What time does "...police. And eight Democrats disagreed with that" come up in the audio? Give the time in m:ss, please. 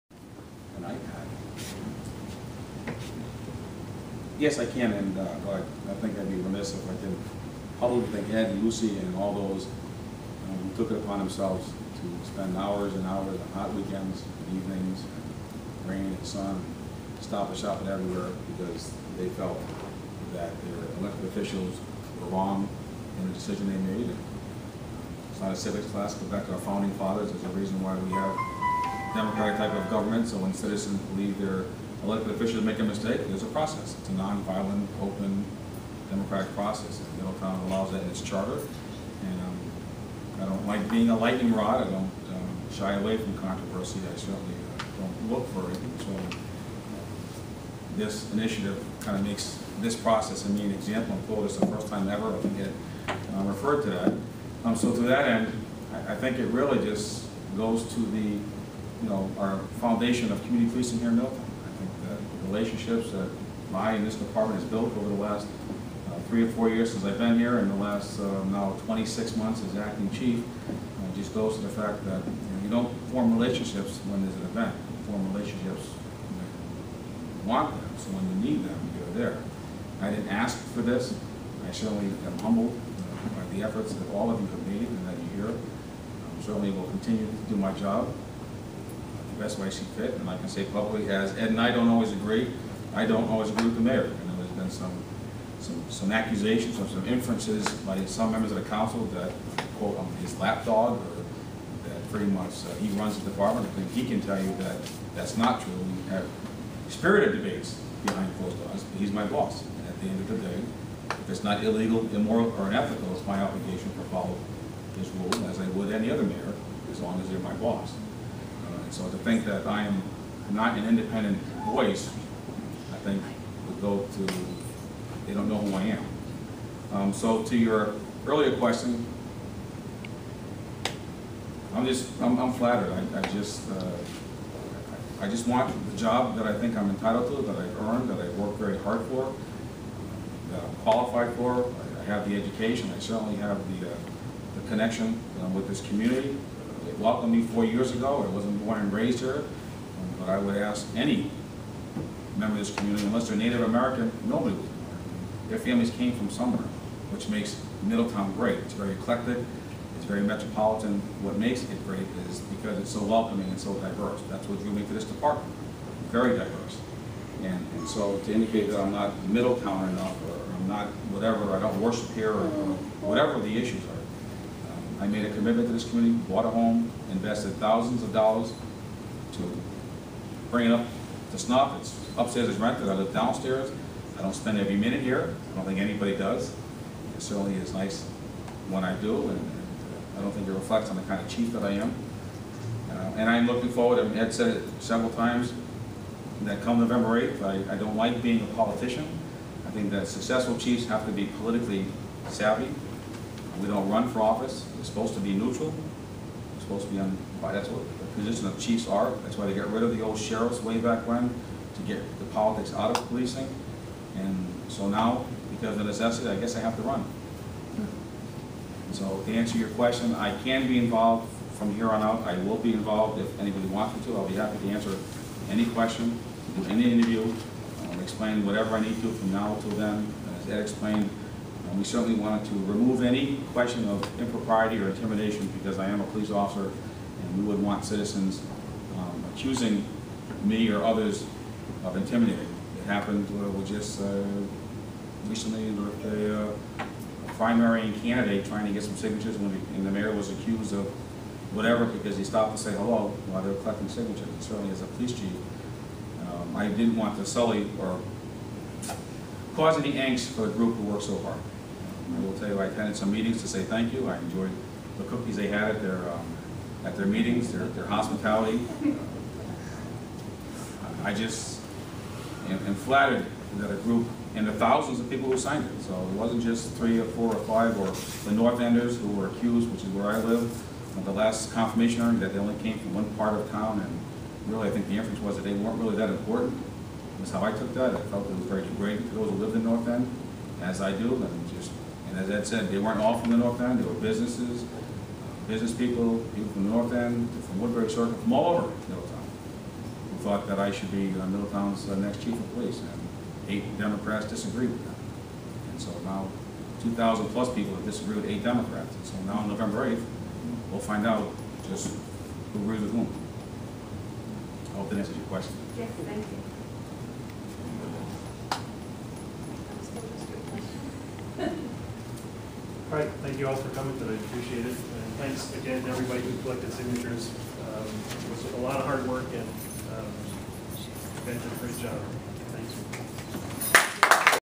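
5:02.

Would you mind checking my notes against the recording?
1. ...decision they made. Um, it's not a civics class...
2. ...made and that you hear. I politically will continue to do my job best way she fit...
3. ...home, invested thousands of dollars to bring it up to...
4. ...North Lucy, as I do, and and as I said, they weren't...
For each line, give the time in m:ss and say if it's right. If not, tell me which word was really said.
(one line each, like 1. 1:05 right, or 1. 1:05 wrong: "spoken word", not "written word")
1. 0:23 right
2. 1:24 wrong: "certainly", not "politically"
3. 2:56 right
4. 4:49 wrong: "End", not "Lucy".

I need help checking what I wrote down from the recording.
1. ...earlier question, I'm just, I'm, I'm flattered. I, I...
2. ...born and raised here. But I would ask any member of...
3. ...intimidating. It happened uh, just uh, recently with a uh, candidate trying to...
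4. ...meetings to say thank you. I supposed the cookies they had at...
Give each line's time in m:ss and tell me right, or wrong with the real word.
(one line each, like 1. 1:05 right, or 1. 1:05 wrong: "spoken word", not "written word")
1. 2:08 right
2. 2:28 right
3. 4:01 right
4. 4:23 wrong: "enjoyed", not "supposed".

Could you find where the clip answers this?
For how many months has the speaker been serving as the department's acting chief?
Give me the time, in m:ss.
1:08.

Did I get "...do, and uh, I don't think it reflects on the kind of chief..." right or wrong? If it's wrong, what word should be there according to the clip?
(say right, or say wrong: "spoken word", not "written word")
right.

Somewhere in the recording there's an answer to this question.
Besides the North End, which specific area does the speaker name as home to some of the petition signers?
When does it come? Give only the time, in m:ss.
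4:57.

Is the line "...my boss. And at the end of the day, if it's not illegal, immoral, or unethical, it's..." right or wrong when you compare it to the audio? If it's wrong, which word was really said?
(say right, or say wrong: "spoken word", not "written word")
right.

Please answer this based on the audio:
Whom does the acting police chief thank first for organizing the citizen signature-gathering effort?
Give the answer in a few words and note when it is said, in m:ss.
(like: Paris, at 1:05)
Ed Lucy, at 0:08.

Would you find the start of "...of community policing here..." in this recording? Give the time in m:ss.
1:00.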